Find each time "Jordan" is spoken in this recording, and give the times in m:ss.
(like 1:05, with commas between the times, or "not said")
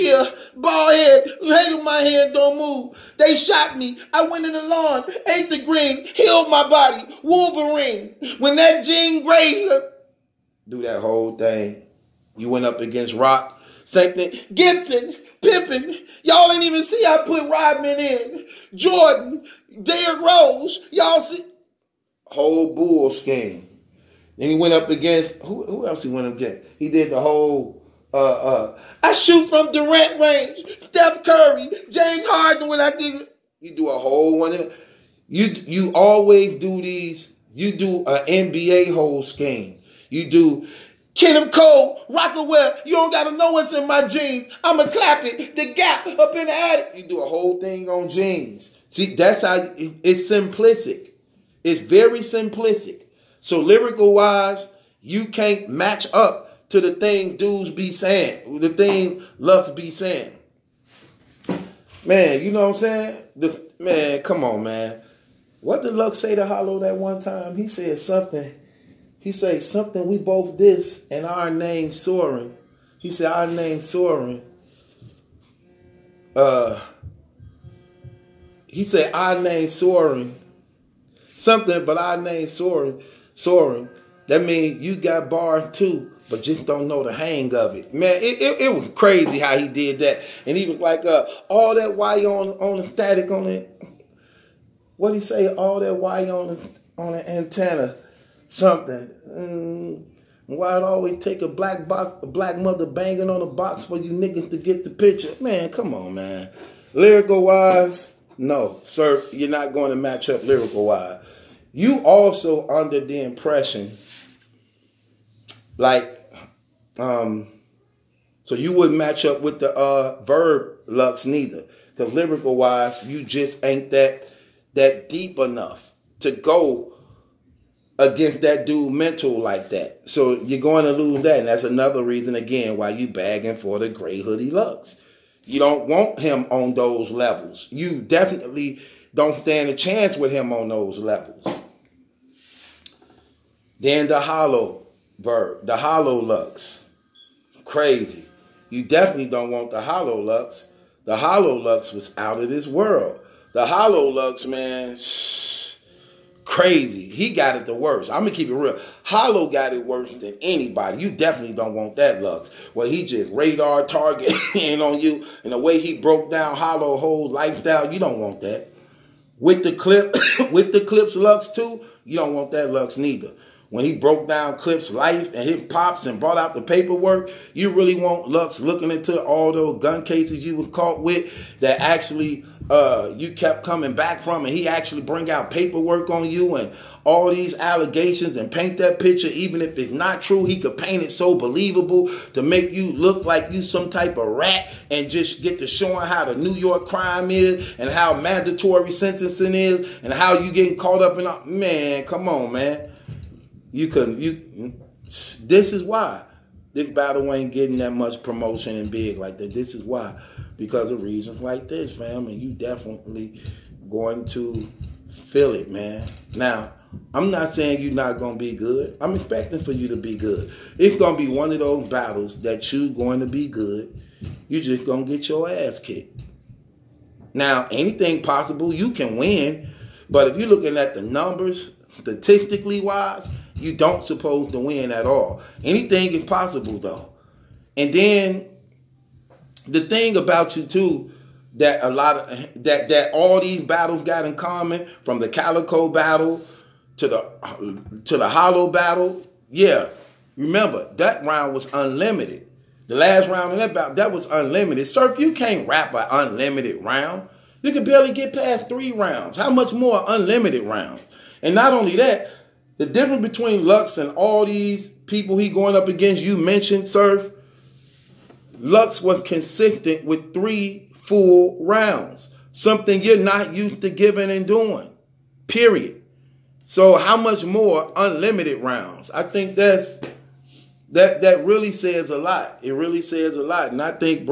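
0:18.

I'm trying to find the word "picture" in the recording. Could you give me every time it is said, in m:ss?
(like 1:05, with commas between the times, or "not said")
1:44, 3:08.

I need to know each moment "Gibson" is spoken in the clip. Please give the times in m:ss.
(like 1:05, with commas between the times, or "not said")
0:14.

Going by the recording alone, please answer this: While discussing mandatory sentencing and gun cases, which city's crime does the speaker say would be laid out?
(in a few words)
New York.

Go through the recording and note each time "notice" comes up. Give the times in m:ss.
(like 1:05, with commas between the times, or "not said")
not said.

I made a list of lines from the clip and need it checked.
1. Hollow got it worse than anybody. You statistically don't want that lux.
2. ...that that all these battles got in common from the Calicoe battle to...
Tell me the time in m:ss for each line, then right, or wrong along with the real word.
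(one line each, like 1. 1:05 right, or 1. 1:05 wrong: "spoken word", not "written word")
1. 2:39 wrong: "definitely", not "statistically"
2. 4:02 right.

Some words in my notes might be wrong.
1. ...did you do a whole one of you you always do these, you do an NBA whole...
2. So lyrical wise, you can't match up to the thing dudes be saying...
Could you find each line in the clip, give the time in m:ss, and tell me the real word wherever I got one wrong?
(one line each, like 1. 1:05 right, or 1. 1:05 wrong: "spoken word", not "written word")
1. 0:32 right
2. 0:53 right.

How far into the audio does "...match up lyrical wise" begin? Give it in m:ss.
1:49.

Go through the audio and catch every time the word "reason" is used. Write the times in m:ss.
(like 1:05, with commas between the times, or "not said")
2:12, 3:31.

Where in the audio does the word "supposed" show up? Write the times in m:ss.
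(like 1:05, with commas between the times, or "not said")
3:54.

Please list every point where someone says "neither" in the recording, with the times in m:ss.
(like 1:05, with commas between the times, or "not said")
2:01, 2:52.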